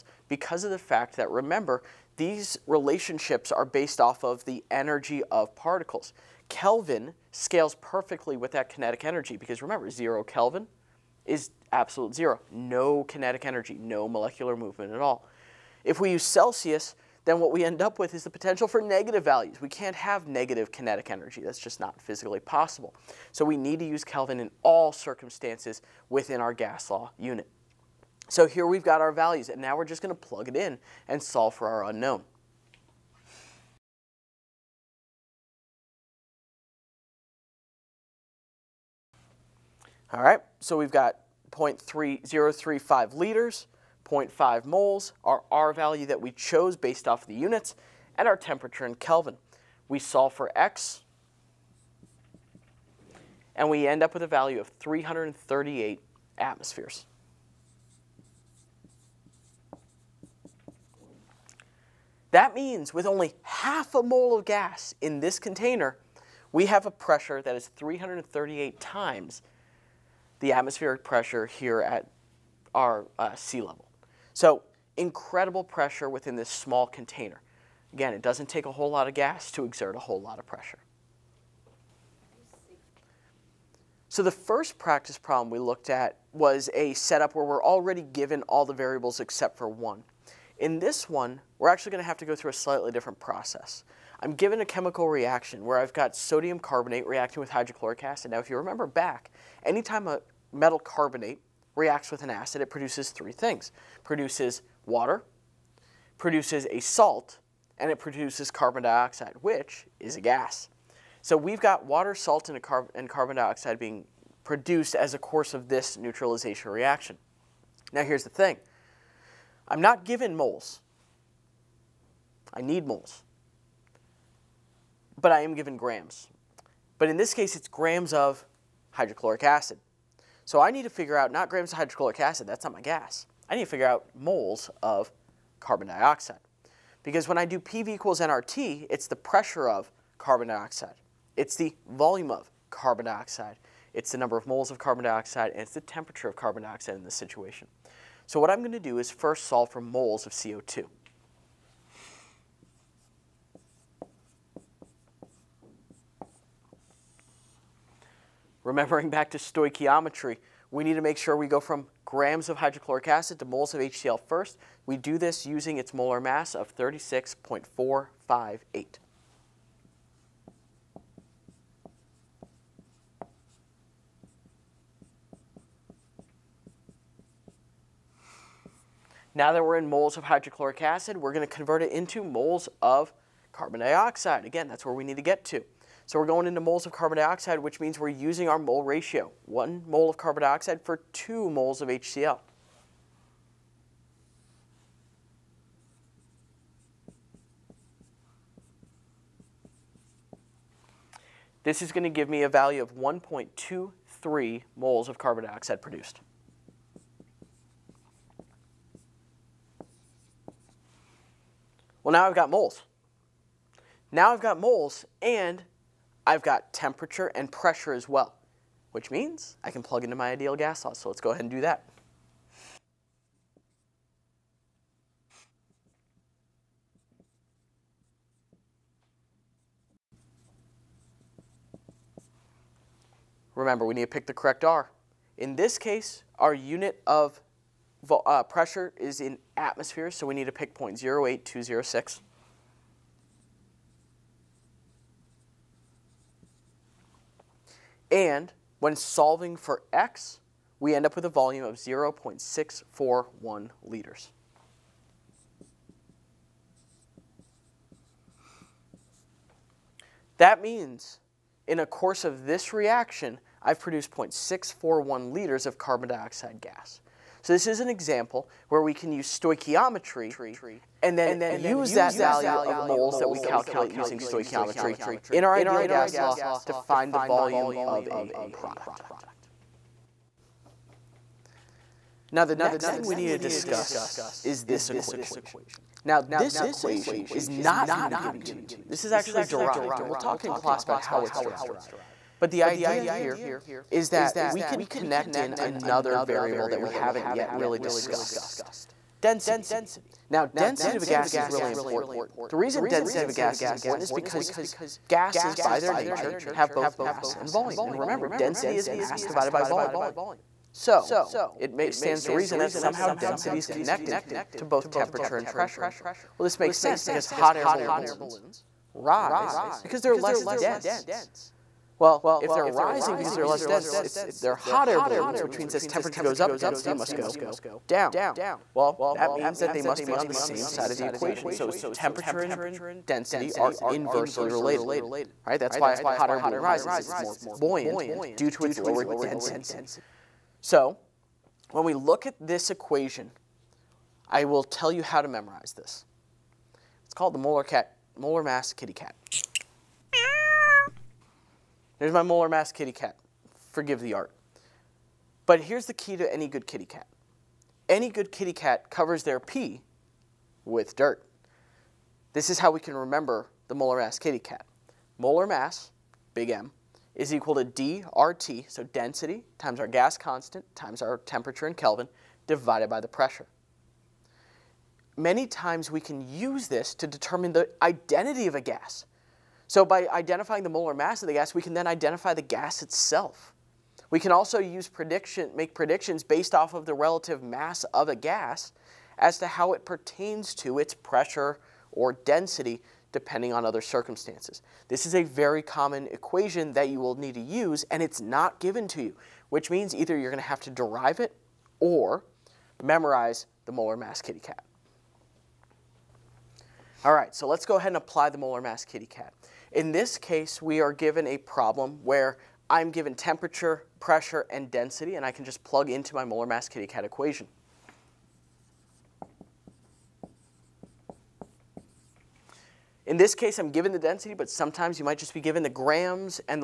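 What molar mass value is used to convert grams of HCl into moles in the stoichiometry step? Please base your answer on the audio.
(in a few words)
36.458.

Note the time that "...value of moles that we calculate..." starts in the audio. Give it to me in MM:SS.
04:32.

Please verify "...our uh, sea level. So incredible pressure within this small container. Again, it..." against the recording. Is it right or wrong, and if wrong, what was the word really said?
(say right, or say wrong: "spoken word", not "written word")
right.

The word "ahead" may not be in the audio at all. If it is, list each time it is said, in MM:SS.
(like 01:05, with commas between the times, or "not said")
03:41, 06:47.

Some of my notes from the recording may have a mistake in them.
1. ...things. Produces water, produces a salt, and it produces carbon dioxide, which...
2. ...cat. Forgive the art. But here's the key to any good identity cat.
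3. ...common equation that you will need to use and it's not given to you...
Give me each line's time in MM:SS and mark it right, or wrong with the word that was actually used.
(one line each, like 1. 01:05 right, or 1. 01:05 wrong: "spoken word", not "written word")
1. 01:43 right
2. 05:52 wrong: "kitty", not "identity"
3. 06:35 right.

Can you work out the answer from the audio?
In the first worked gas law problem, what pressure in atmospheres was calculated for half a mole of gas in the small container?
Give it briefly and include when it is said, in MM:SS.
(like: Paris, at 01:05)
338 atmospheres, at 00:54.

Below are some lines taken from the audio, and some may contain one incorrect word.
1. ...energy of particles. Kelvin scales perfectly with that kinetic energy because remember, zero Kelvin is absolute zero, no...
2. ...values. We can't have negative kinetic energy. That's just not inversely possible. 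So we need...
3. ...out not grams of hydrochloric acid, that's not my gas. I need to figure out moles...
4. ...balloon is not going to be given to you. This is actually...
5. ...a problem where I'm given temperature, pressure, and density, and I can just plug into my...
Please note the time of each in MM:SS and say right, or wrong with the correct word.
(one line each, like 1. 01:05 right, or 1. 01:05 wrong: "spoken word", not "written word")
1. 00:04 right
2. 00:19 wrong: "physically", not "inversely"
3. 02:11 right
4. 04:46 wrong: "equation", not "balloon"
5. 06:51 right.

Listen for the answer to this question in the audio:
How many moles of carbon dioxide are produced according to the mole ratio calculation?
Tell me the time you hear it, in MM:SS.
03:22.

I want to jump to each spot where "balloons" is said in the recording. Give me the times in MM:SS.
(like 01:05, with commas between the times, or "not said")
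05:17, 05:25, 05:36.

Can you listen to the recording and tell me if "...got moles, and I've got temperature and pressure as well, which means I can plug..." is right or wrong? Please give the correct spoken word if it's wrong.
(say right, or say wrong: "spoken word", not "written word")
right.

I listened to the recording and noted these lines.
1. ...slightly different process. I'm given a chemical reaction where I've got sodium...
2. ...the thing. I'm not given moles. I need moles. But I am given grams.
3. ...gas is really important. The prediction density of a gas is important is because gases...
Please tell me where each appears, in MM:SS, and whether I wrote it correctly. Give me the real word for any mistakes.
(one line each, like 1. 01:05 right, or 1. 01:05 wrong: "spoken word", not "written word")
1. 01:32 right
2. 01:58 right
3. 05:01 wrong: "reason", not "prediction".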